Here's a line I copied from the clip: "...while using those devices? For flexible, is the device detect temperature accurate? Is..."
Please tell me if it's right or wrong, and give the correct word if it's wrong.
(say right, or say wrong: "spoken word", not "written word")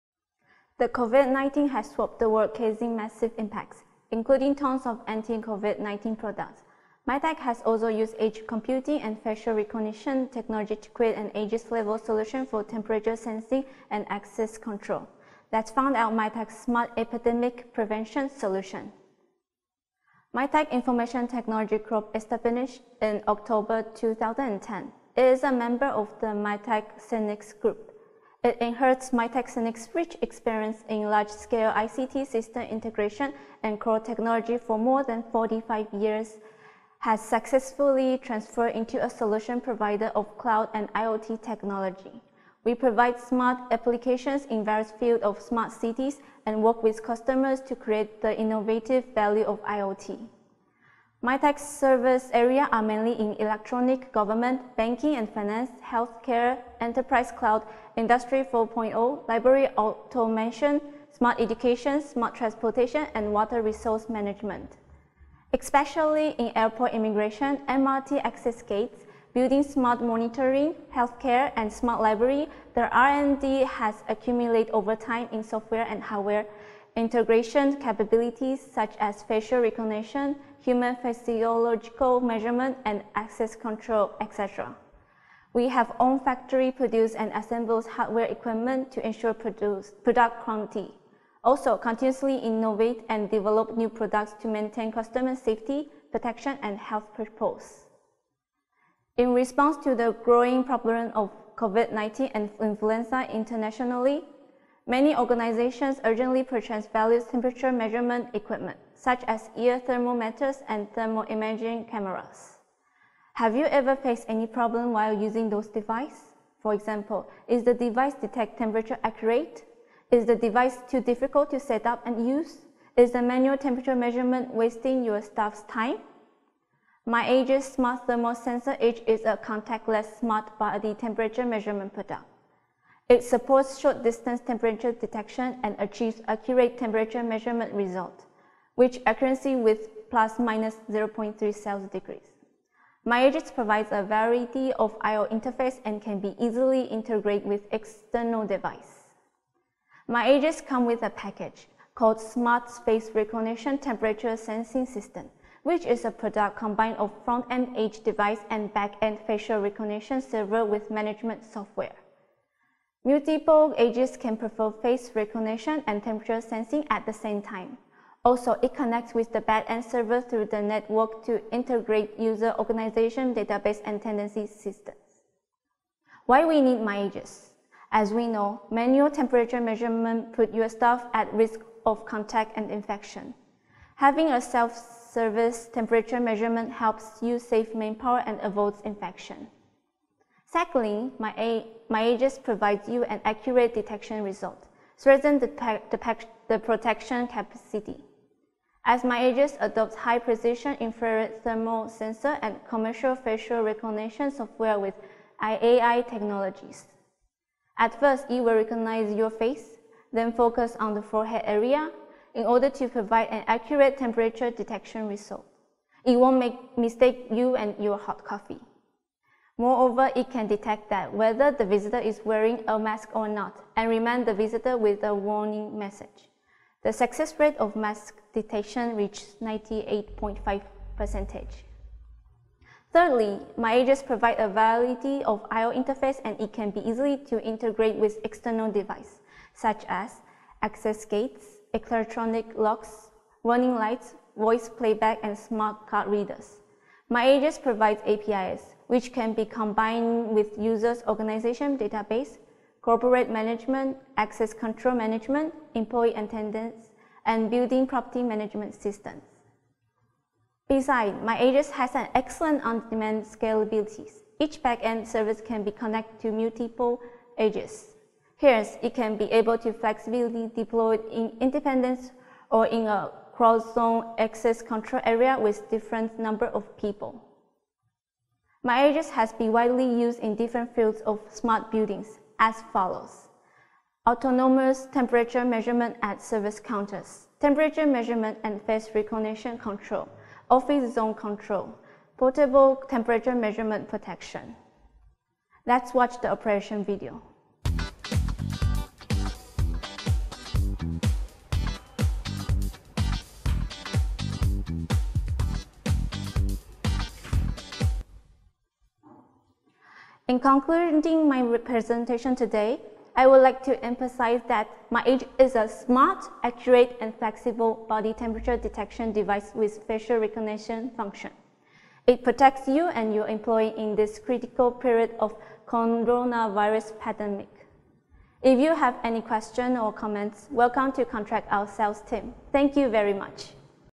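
wrong: "example", not "flexible".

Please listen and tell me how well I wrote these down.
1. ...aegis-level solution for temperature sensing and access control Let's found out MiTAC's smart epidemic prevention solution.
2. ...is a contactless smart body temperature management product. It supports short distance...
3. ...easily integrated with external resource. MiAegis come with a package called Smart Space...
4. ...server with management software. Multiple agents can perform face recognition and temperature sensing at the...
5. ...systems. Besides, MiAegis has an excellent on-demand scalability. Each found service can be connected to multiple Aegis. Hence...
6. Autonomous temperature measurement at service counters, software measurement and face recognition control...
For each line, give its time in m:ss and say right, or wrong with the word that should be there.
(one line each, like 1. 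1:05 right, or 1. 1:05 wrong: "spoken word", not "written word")
1. 0:11 right
2. 2:09 wrong: "measurement", not "management"
3. 2:26 wrong: "device", not "resource"
4. 2:40 right
5. 4:18 wrong: "backend", not "found"
6. 4:44 wrong: "temperature", not "software".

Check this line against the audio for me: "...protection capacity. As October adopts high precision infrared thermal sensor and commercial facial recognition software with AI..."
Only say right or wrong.
wrong.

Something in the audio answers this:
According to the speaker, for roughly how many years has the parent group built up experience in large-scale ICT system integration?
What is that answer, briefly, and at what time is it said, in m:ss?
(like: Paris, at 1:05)
45 years, at 0:35.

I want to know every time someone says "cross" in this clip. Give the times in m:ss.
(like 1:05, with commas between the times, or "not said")
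4:33.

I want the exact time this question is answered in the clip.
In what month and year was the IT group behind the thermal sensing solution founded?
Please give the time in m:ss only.
0:23.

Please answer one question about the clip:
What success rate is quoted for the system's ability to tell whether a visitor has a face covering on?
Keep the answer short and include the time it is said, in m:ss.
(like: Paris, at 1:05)
98.5 percent, at 3:49.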